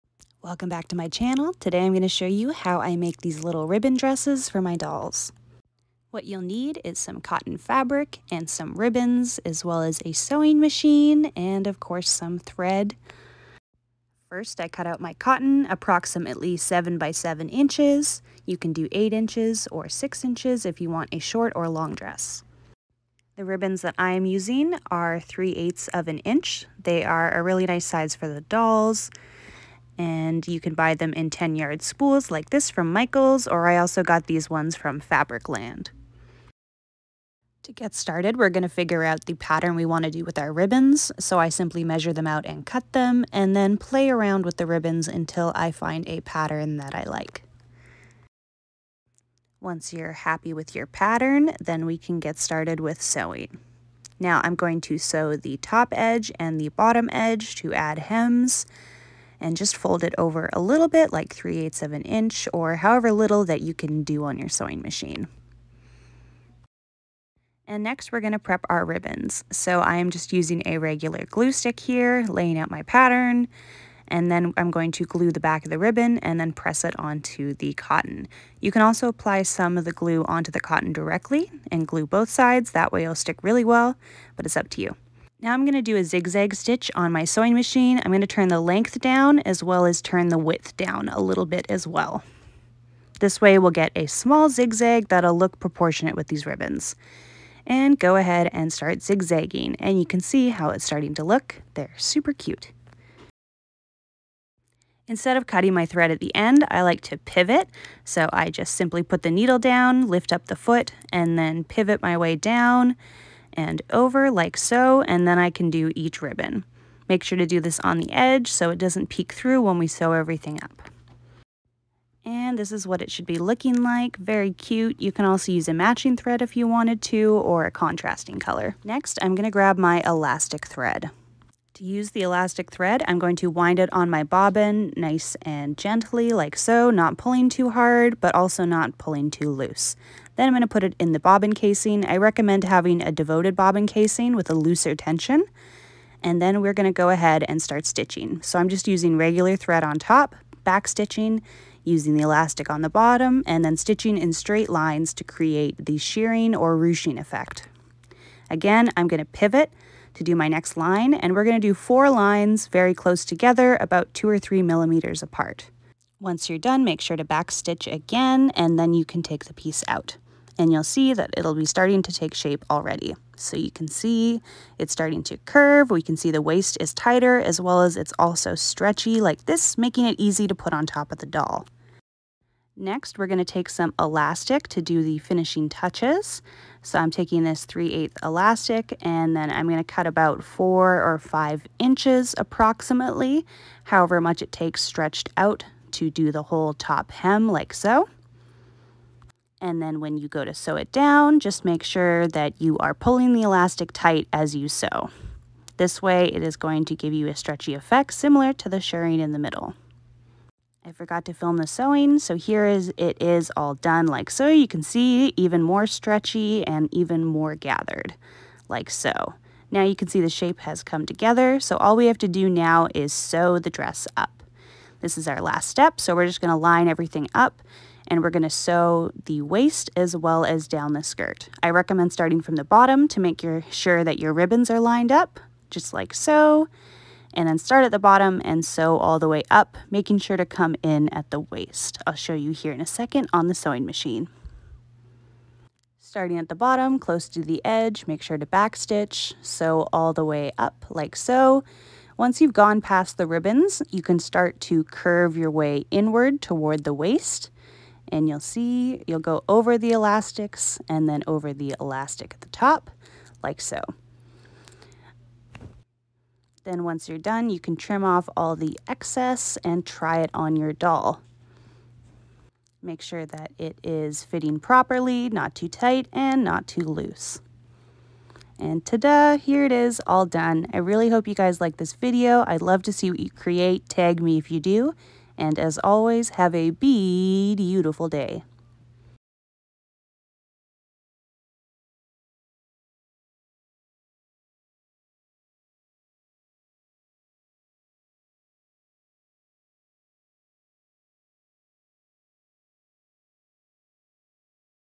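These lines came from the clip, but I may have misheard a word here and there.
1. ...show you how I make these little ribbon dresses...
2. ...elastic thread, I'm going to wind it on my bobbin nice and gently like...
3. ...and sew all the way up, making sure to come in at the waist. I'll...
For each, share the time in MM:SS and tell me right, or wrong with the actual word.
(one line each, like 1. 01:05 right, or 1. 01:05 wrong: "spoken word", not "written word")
1. 00:02 right
2. 02:12 right
3. 03:58 right.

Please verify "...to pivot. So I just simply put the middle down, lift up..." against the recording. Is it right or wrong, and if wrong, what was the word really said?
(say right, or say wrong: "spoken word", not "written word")
wrong: "needle", not "middle".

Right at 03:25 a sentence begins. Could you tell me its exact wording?
This way it is going to give you a stretchy effect similar to the shirring in the middle.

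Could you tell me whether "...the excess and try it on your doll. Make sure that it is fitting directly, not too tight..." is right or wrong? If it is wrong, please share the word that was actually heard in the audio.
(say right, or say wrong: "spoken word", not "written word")
wrong: "properly", not "directly".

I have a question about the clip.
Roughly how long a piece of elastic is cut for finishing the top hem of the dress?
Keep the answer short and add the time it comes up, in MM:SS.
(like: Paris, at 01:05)
4 or 5 inches, at 03:10.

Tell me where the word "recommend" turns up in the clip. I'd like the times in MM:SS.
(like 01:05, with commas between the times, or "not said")
02:22, 03:51.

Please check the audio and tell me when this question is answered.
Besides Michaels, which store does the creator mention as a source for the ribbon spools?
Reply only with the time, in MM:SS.
00:34.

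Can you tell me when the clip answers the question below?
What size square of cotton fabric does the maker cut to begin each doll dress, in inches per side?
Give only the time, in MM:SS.
00:16.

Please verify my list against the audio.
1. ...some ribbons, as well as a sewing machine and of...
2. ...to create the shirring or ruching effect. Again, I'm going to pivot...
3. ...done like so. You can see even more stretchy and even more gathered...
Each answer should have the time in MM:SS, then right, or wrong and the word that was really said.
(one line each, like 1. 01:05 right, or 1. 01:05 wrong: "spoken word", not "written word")
1. 00:08 right
2. 02:35 right
3. 03:33 right.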